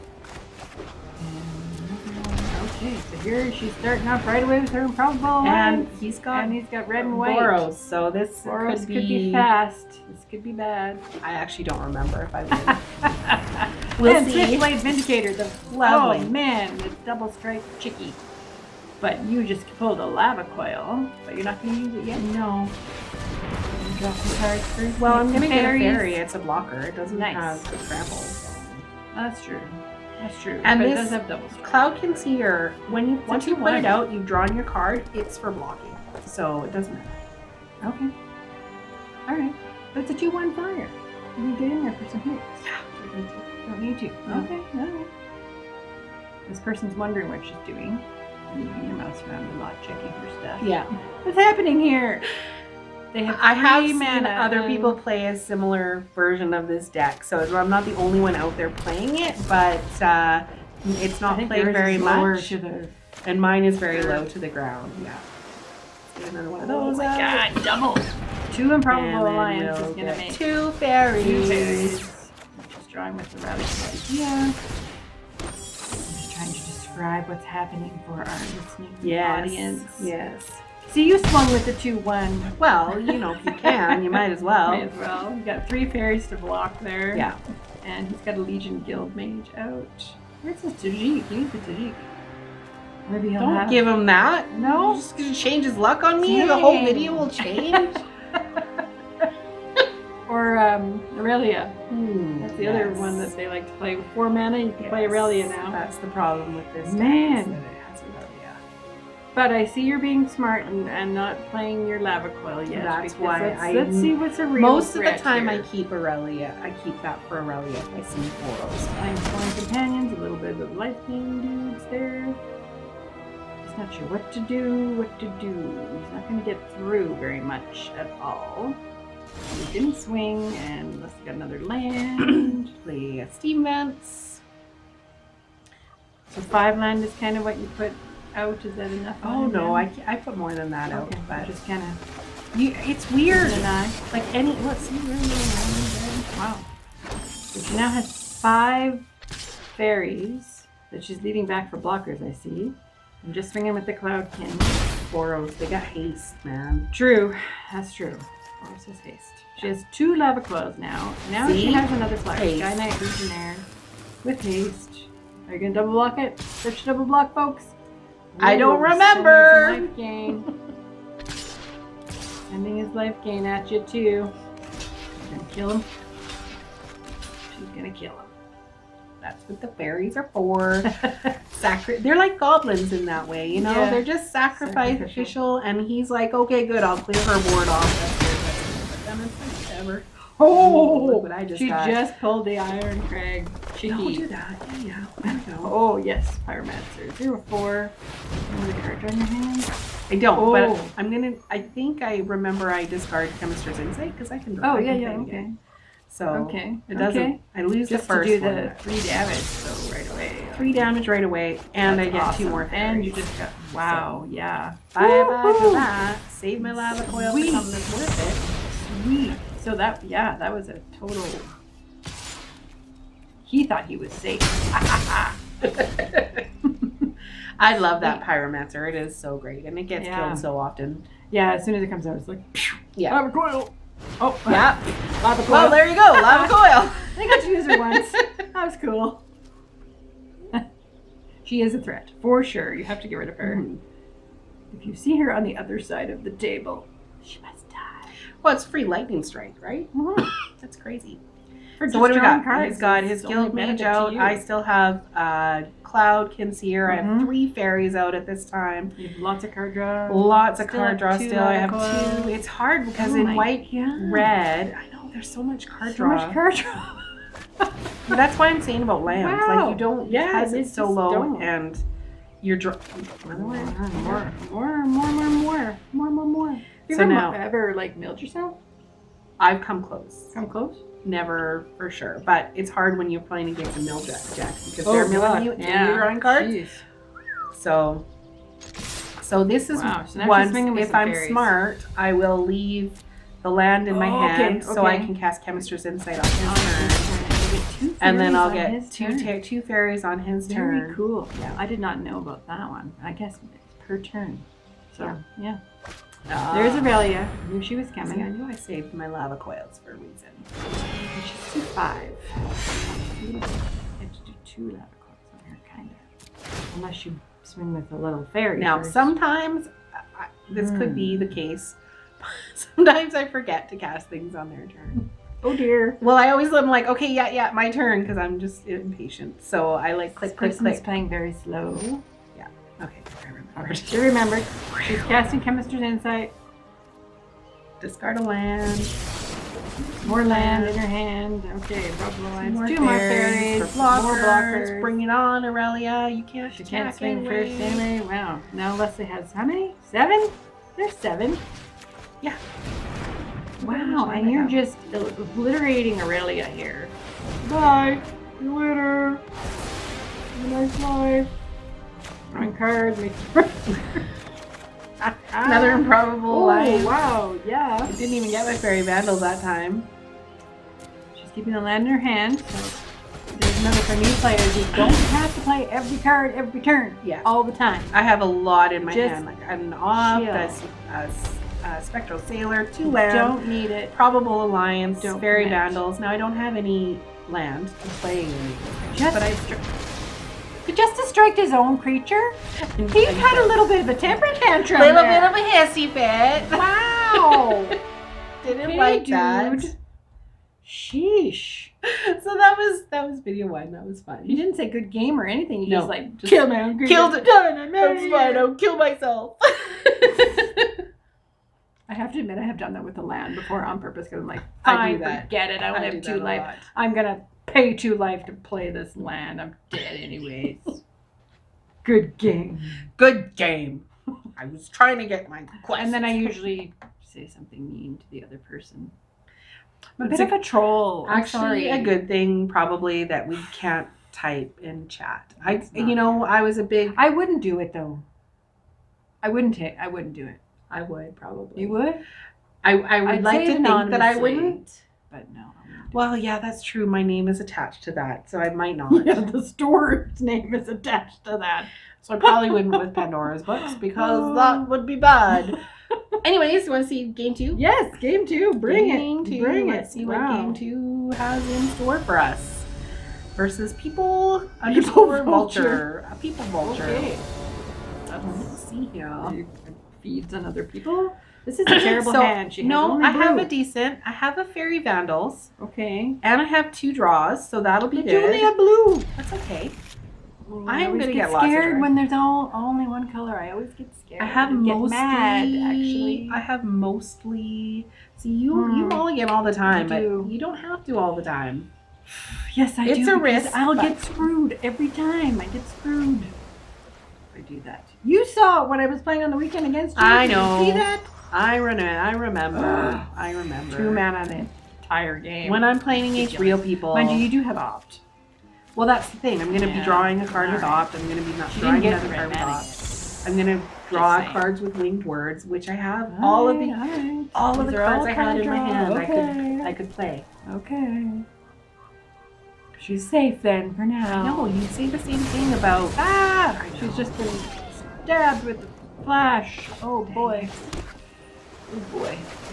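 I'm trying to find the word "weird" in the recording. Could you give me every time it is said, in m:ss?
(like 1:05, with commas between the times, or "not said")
2:23.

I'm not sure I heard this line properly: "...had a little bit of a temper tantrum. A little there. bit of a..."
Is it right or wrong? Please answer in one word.
right.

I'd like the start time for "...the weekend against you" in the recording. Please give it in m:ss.
8:19.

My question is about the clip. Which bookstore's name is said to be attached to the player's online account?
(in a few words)
Pandora's Books.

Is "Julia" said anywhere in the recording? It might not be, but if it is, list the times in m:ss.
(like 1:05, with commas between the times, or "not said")
7:58.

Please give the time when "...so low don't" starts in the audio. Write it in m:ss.
4:30.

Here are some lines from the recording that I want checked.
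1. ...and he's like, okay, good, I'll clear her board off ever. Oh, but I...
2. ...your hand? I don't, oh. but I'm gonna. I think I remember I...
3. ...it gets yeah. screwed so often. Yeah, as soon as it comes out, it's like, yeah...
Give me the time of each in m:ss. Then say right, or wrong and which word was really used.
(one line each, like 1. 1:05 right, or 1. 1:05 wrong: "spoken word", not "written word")
1. 3:05 right
2. 3:19 right
3. 3:49 wrong: "killed", not "screwed".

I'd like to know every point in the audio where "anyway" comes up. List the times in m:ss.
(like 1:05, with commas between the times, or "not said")
5:47, 6:59, 7:36.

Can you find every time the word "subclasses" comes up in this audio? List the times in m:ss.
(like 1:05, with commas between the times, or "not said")
not said.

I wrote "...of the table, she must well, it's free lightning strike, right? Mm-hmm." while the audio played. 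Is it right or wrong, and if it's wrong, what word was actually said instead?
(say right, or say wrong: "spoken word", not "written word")
right.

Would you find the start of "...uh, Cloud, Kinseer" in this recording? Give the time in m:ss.
4:15.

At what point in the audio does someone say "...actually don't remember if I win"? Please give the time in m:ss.
0:11.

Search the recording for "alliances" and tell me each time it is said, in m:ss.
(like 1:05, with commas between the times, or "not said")
1:09, 6:24.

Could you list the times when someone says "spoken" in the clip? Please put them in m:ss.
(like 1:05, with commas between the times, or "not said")
not said.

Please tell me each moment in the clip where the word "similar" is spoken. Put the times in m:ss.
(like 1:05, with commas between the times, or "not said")
0:55.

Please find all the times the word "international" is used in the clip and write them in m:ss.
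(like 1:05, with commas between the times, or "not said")
not said.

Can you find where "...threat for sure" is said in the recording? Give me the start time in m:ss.
4:01.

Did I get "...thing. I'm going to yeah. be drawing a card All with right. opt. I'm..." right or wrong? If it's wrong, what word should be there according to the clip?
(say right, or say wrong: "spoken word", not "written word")
right.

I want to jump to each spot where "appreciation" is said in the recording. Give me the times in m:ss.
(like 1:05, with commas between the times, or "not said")
not said.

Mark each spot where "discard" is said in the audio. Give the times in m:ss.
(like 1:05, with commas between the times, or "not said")
3:22, 5:37.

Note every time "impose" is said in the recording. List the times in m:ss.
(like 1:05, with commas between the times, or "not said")
not said.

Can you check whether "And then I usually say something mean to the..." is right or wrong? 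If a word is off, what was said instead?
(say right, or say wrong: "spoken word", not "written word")
right.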